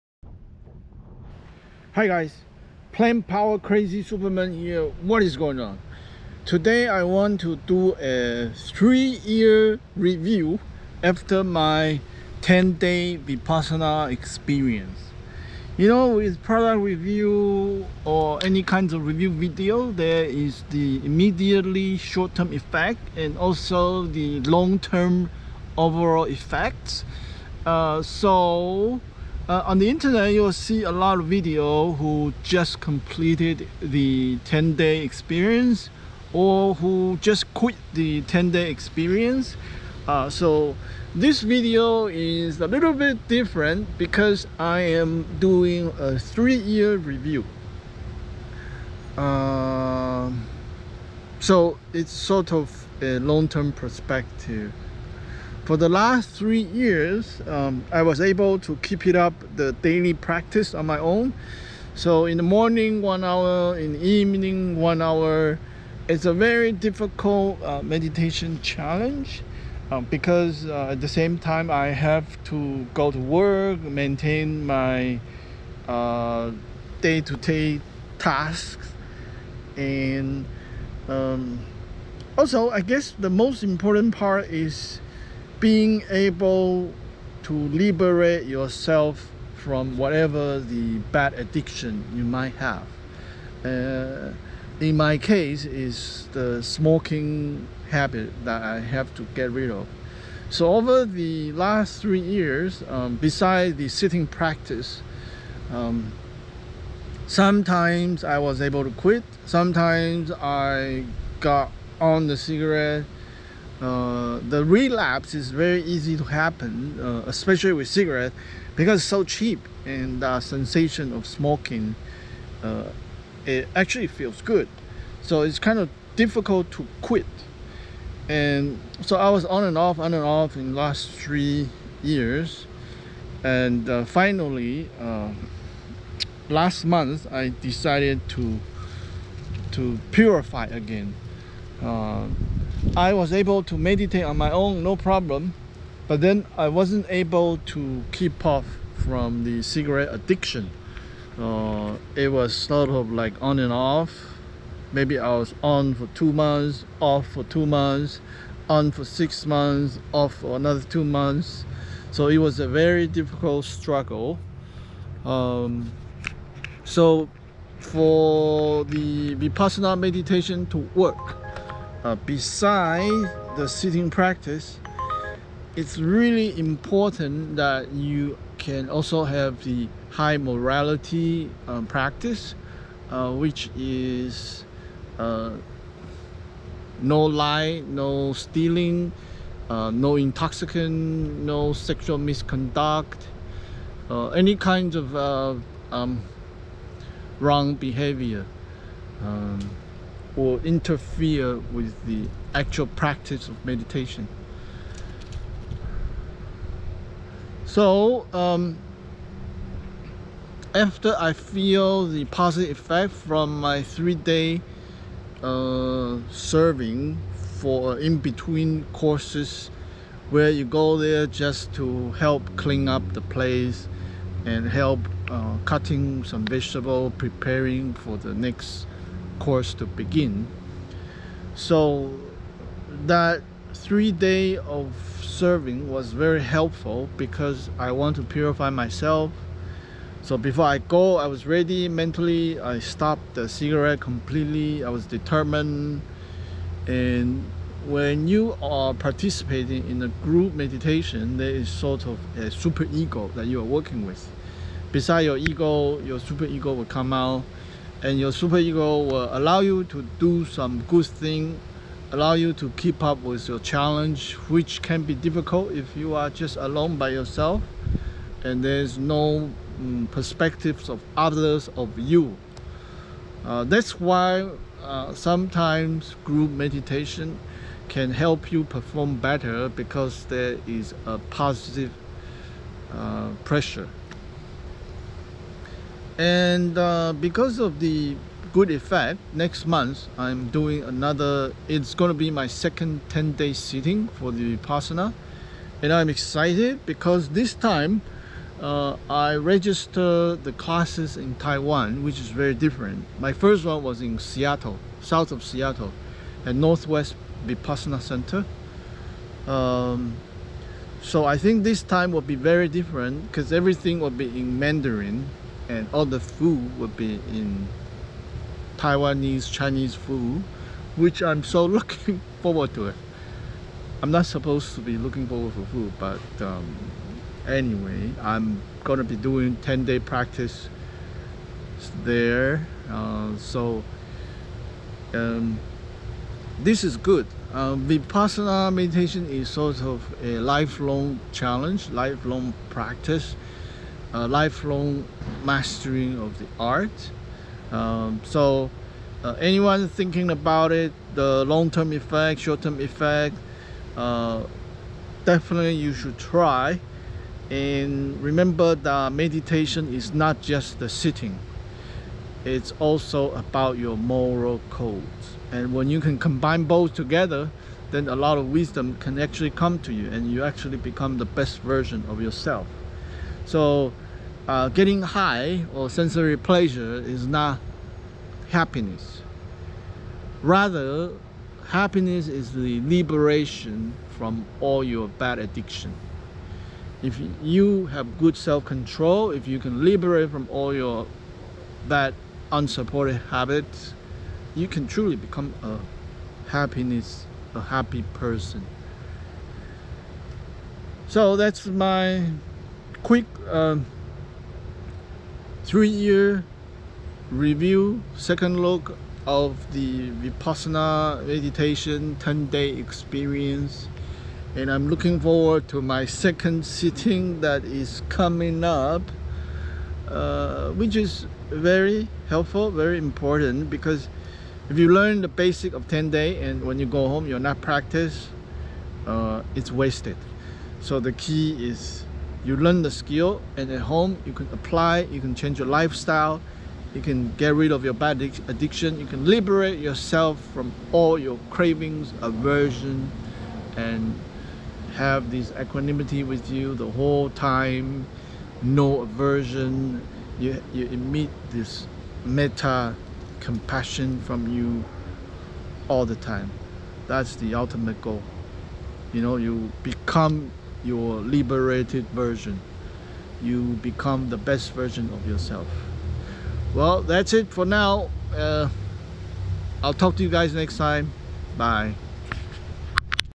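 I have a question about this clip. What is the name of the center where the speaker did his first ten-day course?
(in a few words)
Northwest Vipassana Center.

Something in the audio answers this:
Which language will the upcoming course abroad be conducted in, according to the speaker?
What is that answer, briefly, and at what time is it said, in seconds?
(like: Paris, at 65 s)
Mandarin, at 314 s.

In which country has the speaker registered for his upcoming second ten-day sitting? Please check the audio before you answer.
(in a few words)
Taiwan.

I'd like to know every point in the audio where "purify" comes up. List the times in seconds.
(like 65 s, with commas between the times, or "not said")
140 s, 238 s.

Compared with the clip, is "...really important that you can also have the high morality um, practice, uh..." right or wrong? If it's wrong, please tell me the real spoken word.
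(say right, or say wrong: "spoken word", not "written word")
right.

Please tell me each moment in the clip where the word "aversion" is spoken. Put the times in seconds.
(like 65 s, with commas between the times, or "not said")
442 s, 449 s.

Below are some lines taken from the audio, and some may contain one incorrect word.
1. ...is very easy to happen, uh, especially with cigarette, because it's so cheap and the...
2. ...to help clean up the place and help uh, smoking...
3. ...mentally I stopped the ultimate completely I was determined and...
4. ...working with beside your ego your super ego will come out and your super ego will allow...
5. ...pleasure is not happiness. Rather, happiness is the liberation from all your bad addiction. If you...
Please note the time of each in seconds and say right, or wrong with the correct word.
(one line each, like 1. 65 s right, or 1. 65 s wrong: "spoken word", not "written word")
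1. 115 s right
2. 221 s wrong: "cutting", not "smoking"
3. 241 s wrong: "cigarette", not "ultimate"
4. 253 s right
5. 376 s right.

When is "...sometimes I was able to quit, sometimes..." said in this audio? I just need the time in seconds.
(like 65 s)
107 s.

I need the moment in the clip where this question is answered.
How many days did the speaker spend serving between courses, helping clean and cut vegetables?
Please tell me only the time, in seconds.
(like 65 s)
233 s.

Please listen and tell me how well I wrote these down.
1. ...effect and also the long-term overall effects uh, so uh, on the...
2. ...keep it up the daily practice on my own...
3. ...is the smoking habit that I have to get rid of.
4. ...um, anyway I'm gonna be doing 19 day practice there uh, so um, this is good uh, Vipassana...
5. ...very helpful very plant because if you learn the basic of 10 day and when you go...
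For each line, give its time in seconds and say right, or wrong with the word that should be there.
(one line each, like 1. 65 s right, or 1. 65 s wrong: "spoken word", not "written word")
1. 22 s right
2. 58 s right
3. 95 s right
4. 326 s wrong: "10", not "19"
5. 421 s wrong: "important", not "plant".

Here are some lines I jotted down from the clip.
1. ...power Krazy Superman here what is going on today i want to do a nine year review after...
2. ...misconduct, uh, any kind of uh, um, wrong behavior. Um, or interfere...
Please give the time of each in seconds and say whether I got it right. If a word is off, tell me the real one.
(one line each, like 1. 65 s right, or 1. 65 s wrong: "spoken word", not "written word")
1. 3 s wrong: "three", not "nine"
2. 192 s right.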